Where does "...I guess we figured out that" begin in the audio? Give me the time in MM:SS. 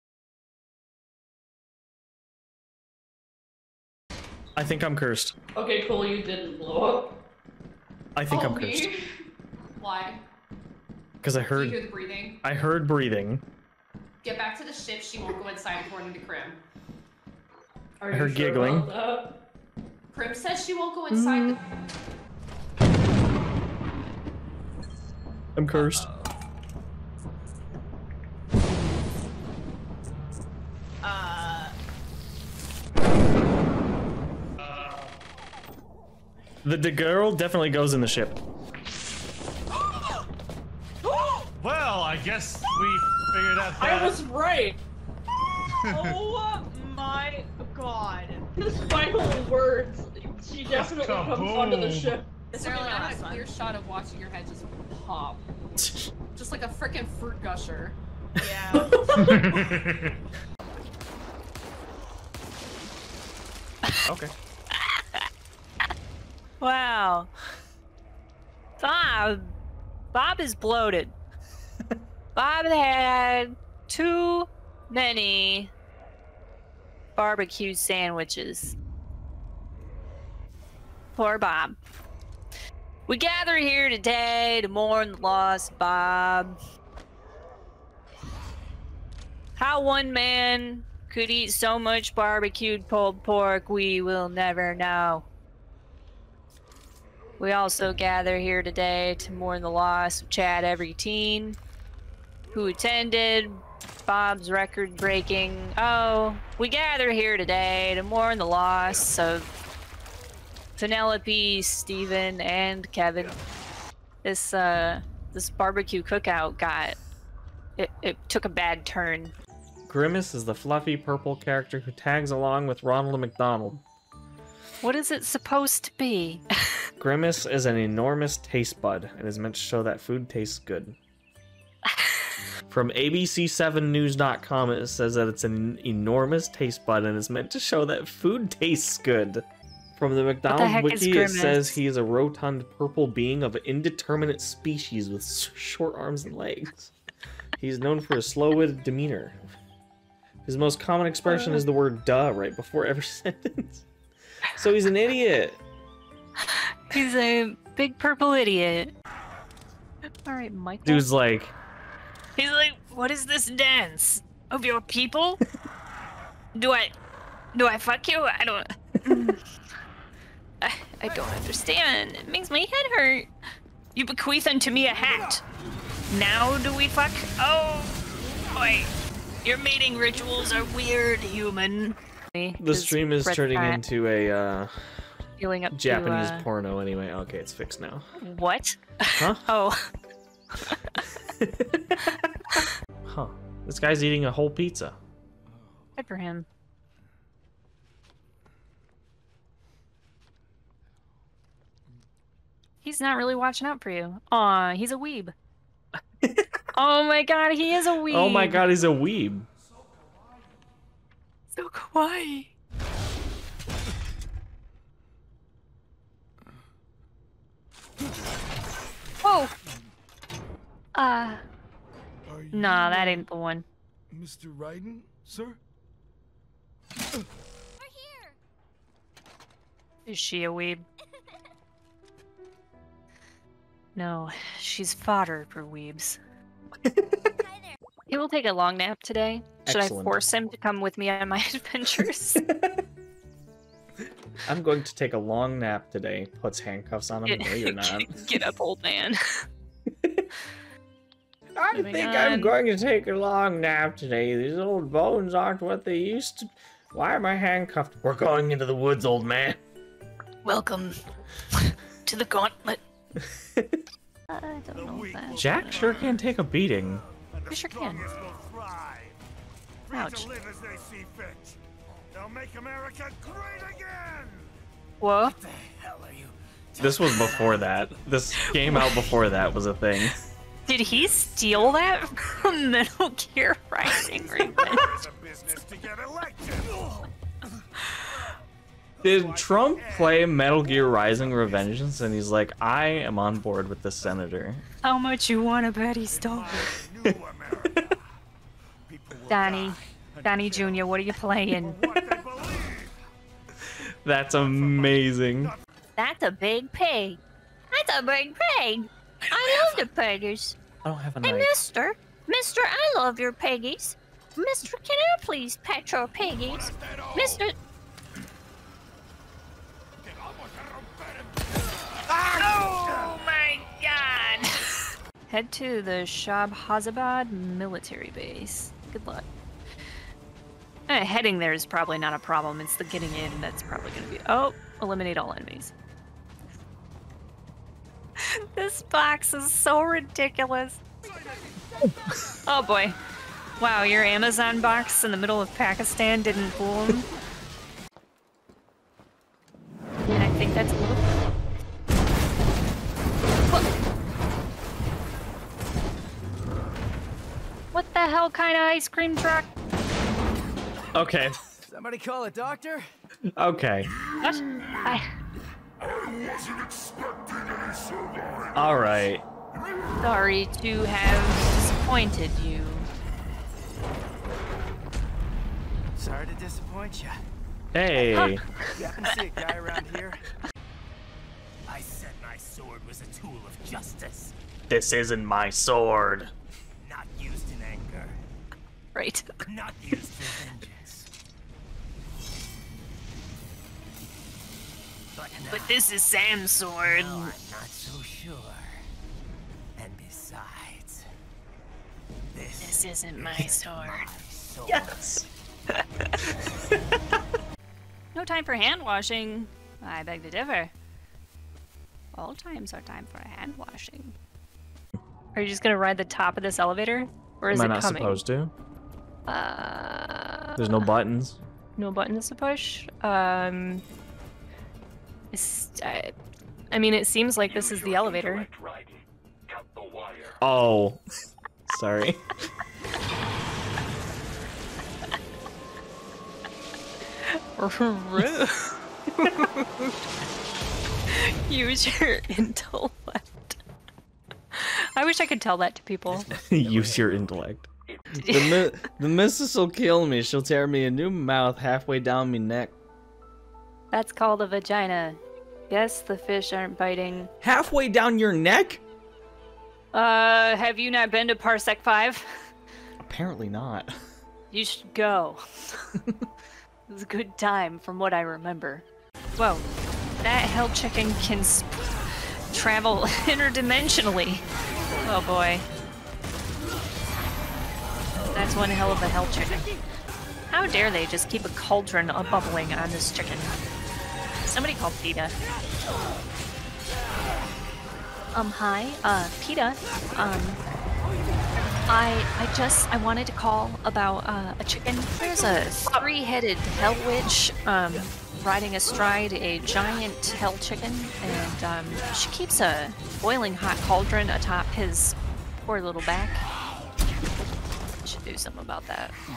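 00:42.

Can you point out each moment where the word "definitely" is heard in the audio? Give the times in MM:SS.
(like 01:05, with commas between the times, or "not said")
00:37, 00:50.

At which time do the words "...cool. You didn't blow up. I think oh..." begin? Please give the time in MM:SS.
00:05.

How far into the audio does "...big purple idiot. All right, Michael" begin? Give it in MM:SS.
02:37.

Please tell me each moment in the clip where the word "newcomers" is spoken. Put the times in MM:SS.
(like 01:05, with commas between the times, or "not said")
not said.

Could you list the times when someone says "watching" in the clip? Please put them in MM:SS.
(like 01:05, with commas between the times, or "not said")
00:53, 03:23.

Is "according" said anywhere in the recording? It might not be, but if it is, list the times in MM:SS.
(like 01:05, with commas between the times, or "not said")
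00:15.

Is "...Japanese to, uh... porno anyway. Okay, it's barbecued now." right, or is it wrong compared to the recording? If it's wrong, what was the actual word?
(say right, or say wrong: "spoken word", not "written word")
wrong: "fixed", not "barbecued".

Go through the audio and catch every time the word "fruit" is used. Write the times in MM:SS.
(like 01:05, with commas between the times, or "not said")
00:57.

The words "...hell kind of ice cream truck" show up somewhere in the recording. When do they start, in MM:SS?
05:57.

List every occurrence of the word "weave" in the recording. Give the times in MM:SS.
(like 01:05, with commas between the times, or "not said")
not said.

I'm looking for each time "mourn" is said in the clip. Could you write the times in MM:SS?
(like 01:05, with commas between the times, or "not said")
01:24, 01:39, 01:48.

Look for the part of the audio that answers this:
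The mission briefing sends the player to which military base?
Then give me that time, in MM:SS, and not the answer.
05:26.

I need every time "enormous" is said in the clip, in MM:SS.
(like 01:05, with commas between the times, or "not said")
02:07, 02:15.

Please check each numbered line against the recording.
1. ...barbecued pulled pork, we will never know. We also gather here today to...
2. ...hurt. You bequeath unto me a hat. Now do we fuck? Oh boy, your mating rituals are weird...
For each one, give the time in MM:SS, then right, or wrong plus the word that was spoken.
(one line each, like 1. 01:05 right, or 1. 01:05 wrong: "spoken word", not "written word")
1. 01:32 right
2. 02:52 right.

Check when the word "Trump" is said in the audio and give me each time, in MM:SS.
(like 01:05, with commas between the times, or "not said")
04:49.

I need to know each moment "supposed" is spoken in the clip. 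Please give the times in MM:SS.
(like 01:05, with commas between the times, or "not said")
02:05, 06:58.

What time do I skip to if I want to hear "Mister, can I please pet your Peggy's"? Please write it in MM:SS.
05:14.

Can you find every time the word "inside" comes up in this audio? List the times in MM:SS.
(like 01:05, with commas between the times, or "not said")
00:15, 00:21.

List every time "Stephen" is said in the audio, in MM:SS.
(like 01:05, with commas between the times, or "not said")
01:51.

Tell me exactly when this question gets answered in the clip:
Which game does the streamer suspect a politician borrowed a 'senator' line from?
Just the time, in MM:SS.
04:50.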